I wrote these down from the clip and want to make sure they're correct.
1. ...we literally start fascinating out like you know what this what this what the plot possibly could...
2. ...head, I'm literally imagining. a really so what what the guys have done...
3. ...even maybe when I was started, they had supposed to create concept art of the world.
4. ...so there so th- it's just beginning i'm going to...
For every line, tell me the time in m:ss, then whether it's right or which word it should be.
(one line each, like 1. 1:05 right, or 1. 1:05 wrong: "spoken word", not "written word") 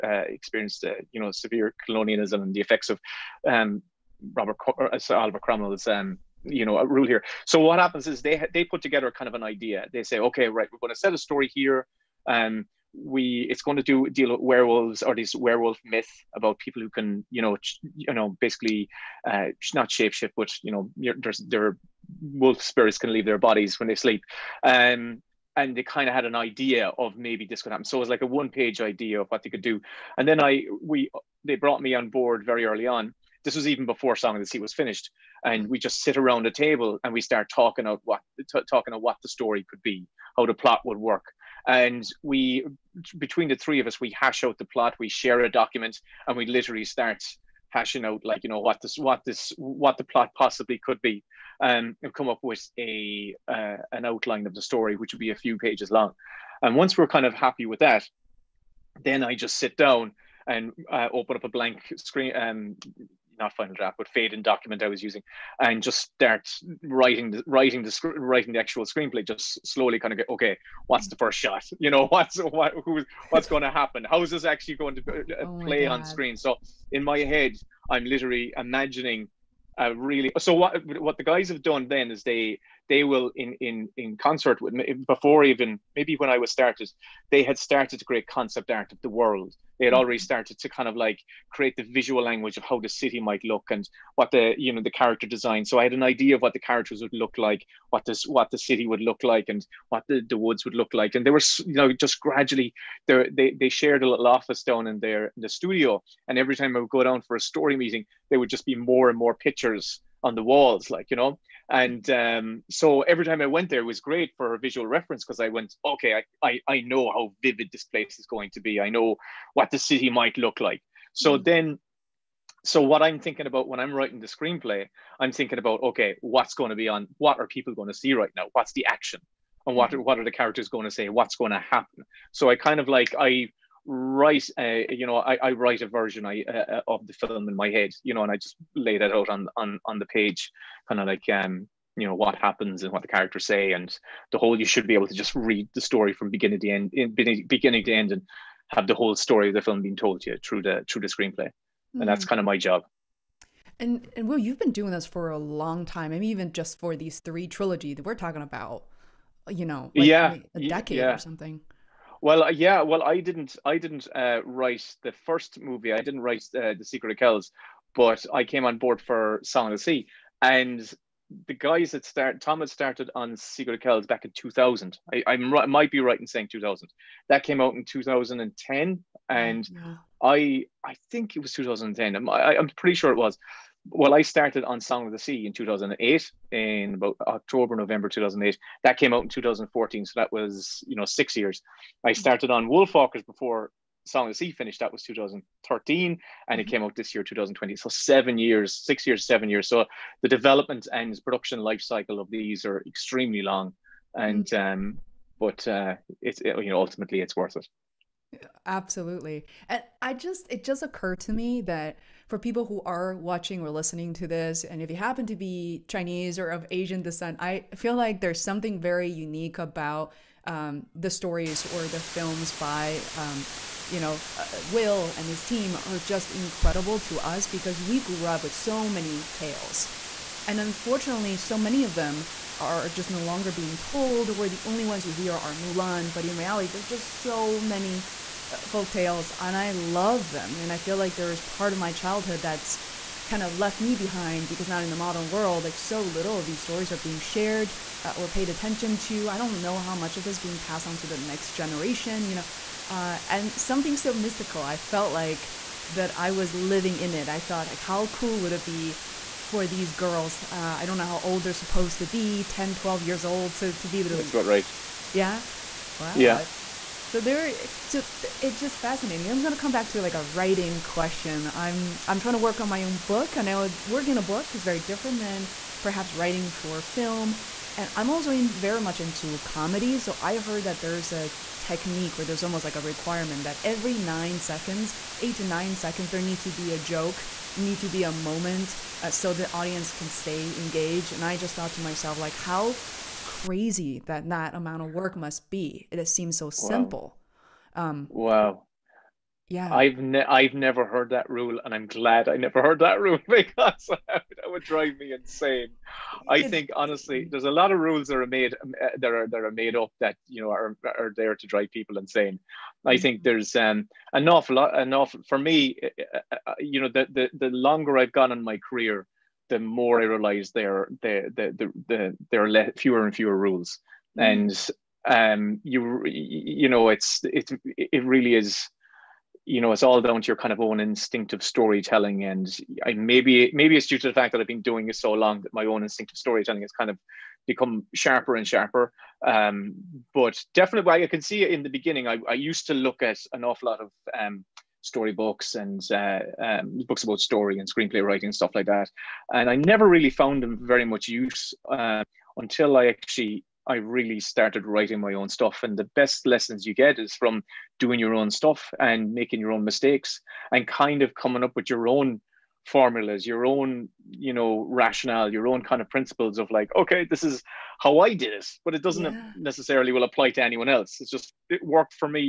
1. 0:46 wrong: "hashing", not "fascinating"
2. 1:17 right
3. 1:25 wrong: "started", not "supposed"
4. 4:27 wrong: "fascinating", not "beginning".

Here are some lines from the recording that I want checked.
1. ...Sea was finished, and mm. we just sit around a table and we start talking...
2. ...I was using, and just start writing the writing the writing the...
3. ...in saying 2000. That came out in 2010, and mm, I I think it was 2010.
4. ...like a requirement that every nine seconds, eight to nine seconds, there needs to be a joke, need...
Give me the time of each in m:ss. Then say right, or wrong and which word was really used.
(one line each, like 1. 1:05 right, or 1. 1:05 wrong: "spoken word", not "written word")
1. 0:34 right
2. 1:04 right
3. 2:56 right
4. 4:42 right.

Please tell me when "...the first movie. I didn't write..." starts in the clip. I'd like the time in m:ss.
2:45.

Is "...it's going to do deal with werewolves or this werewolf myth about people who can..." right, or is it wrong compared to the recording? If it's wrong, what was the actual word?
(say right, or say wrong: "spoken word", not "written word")
right.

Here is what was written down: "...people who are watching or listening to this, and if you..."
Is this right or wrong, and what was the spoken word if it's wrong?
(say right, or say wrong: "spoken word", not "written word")
right.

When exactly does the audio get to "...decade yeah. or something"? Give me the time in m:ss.
2:40.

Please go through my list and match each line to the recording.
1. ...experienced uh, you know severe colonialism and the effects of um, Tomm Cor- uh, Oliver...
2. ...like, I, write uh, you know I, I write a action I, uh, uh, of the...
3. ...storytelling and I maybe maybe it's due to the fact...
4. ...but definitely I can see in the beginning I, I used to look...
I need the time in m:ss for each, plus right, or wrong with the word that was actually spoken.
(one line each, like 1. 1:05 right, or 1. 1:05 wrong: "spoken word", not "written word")
1. 0:00 wrong: "Robert", not "Tomm"
2. 2:12 wrong: "version", not "action"
3. 5:31 right
4. 5:40 right.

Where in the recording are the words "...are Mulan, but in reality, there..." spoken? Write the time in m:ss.
3:55.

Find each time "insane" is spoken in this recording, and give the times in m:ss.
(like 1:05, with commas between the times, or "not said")
5:05, 5:11.